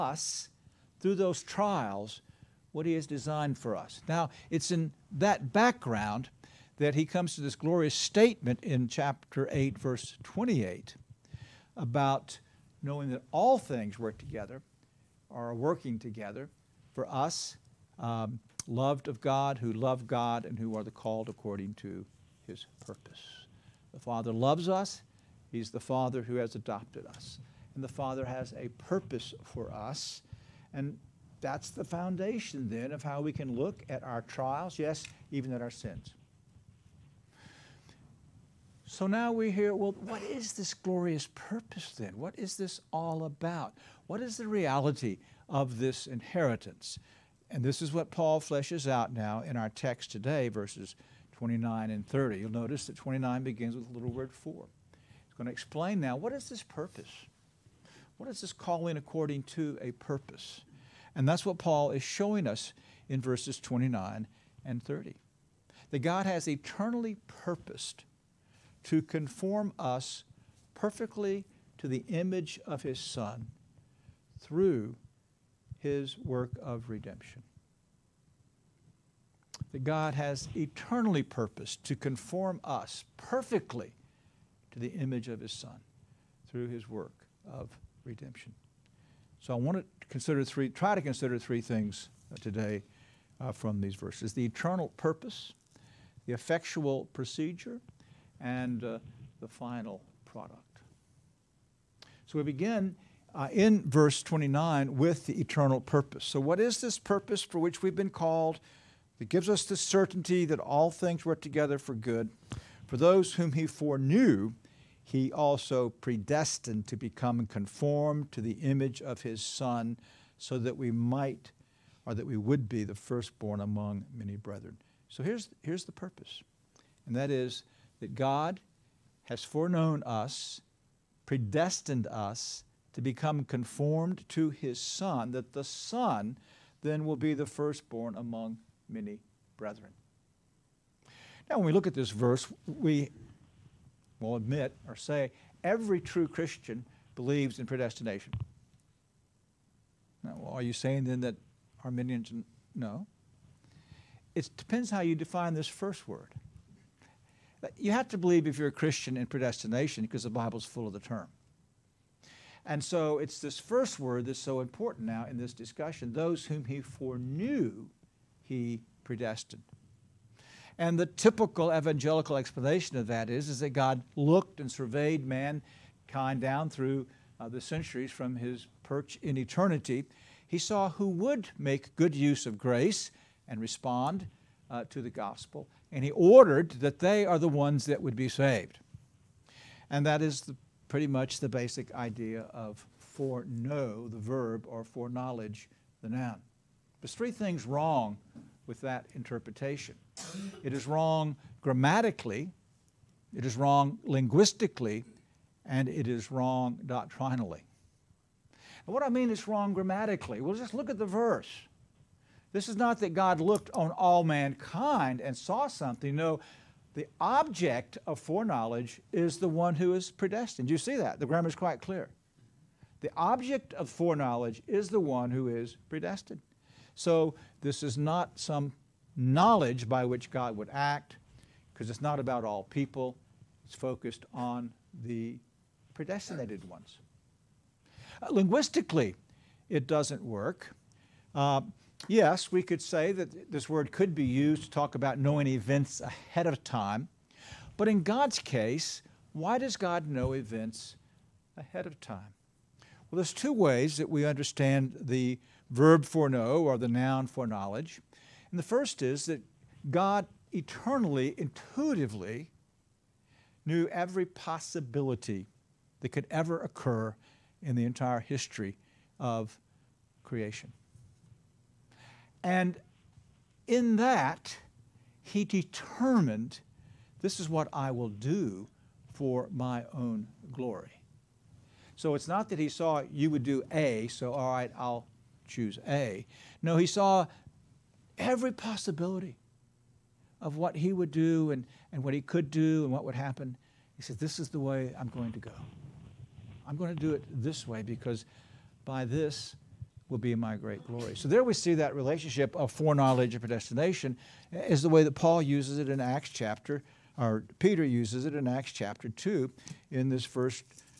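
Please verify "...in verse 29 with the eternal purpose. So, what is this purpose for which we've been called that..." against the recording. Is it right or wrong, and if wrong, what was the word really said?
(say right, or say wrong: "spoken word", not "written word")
right.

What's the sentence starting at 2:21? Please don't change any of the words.
Now, when we look at this verse, we will admit or say every true Christian believes in predestination.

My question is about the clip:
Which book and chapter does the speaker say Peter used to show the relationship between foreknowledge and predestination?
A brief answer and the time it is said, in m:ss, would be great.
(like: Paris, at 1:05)
Acts chapter 2, at 5:08.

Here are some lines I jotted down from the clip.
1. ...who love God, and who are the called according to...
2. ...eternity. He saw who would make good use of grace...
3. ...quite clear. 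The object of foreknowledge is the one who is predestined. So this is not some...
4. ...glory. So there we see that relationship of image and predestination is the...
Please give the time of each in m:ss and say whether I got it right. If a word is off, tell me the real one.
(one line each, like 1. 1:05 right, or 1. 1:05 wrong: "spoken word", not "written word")
1. 0:19 right
2. 2:59 right
3. 3:41 right
4. 5:00 wrong: "foreknowledge", not "image".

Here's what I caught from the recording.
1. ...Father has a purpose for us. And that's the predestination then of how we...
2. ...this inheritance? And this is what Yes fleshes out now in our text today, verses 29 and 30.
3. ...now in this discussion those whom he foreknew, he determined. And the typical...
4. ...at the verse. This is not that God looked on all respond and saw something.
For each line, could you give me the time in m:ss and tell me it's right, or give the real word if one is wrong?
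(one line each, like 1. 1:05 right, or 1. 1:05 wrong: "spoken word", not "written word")
1. 0:27 wrong: "foundation", not "predestination"
2. 0:45 wrong: "Paul", not "Yes"
3. 2:45 wrong: "predestined", not "determined"
4. 3:30 wrong: "mankind", not "respond".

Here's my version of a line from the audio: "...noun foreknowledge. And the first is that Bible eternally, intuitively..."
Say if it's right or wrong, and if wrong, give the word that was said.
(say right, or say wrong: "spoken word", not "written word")
wrong: "God", not "Bible".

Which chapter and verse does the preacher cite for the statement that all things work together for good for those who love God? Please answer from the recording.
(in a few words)
Chapter 8, verse 28.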